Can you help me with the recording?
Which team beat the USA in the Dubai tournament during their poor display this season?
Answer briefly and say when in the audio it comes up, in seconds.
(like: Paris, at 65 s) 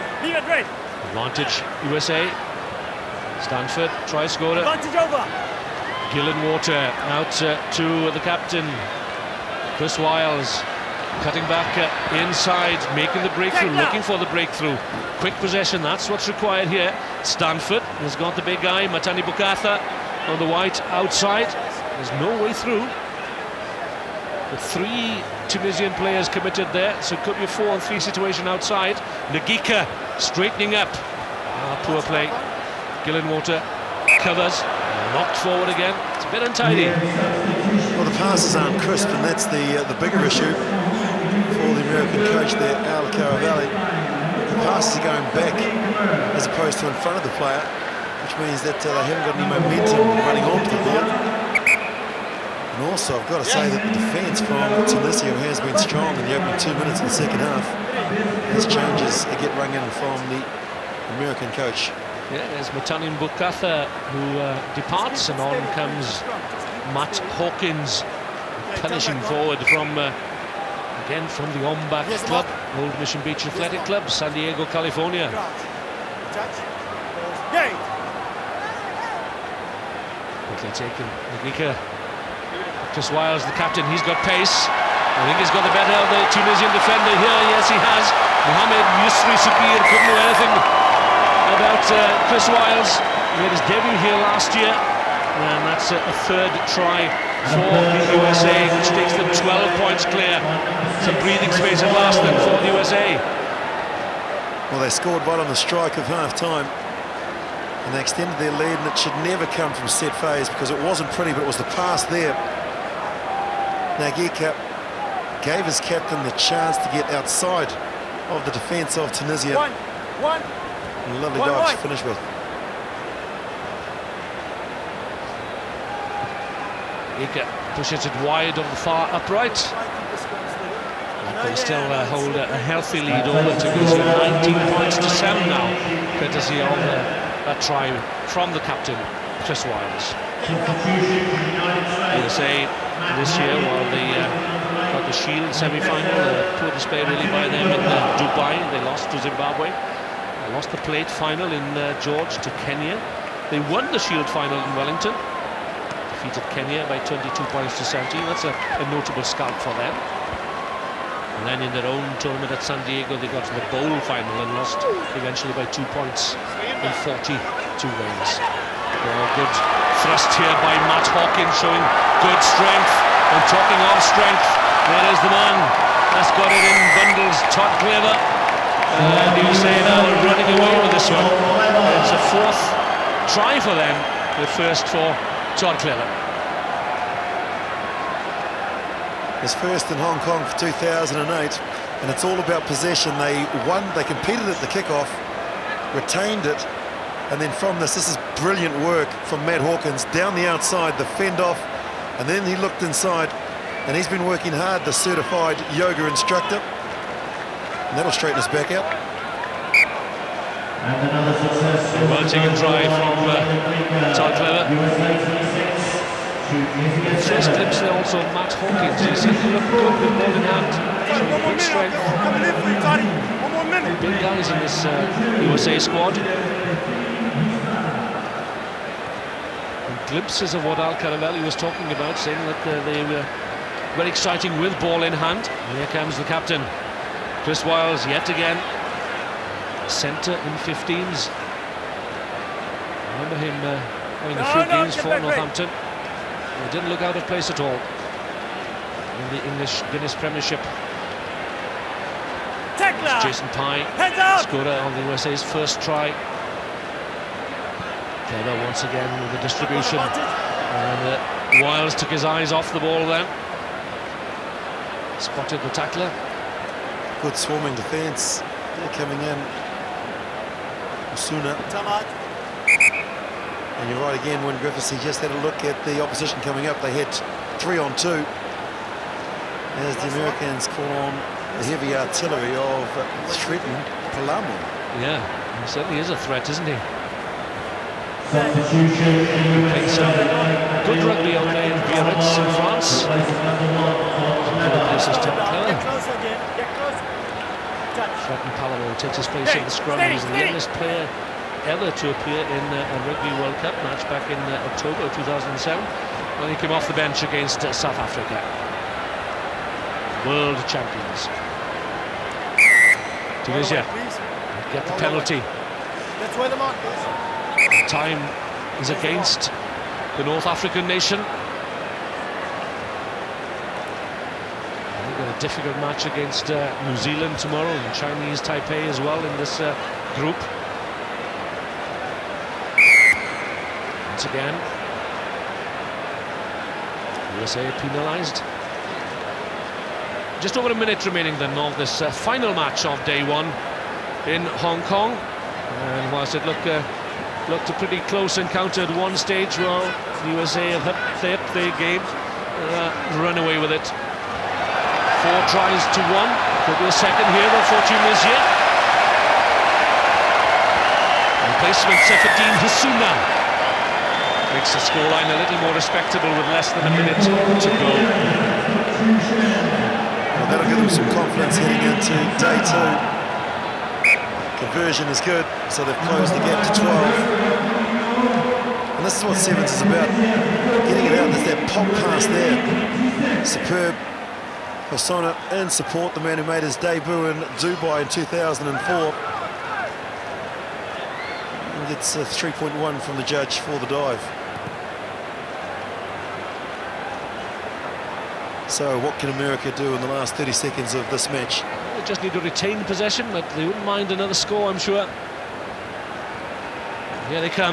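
Zimbabwe, at 149 s.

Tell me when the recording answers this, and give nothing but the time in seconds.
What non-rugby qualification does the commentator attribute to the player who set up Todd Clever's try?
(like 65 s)
204 s.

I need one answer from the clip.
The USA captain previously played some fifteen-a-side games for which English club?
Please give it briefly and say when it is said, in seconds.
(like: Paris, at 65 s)
Northampton, at 245 s.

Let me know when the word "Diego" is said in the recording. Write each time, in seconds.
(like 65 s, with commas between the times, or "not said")
74 s, 162 s.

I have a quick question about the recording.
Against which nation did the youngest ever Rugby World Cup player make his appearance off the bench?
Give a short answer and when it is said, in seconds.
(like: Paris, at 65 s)
South Africa, at 307 s.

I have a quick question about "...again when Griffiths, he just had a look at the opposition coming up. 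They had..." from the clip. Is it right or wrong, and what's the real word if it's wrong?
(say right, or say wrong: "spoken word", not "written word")
right.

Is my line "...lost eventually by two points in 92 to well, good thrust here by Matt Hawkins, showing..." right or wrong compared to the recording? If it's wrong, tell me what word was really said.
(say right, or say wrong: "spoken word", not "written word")
wrong: "42", not "92".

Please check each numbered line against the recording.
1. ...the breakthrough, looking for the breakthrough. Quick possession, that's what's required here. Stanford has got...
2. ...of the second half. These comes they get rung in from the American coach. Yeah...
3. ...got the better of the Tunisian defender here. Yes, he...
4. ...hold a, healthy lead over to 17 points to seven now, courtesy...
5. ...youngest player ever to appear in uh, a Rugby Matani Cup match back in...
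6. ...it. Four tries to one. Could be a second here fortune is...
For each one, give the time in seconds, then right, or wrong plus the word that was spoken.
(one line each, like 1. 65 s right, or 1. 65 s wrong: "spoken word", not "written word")
1. 13 s right
2. 56 s wrong: "changes", not "comes"
3. 85 s right
4. 132 s wrong: "19", not "17"
5. 300 s wrong: "World", not "Matani"
6. 353 s right.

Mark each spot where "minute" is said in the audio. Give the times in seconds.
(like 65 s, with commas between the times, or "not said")
56 s, 223 s, 340 s, 366 s.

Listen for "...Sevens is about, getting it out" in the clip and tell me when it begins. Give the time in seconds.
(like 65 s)
379 s.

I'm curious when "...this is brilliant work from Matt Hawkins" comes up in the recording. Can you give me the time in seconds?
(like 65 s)
197 s.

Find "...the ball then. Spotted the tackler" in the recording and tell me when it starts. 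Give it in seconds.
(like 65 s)
262 s.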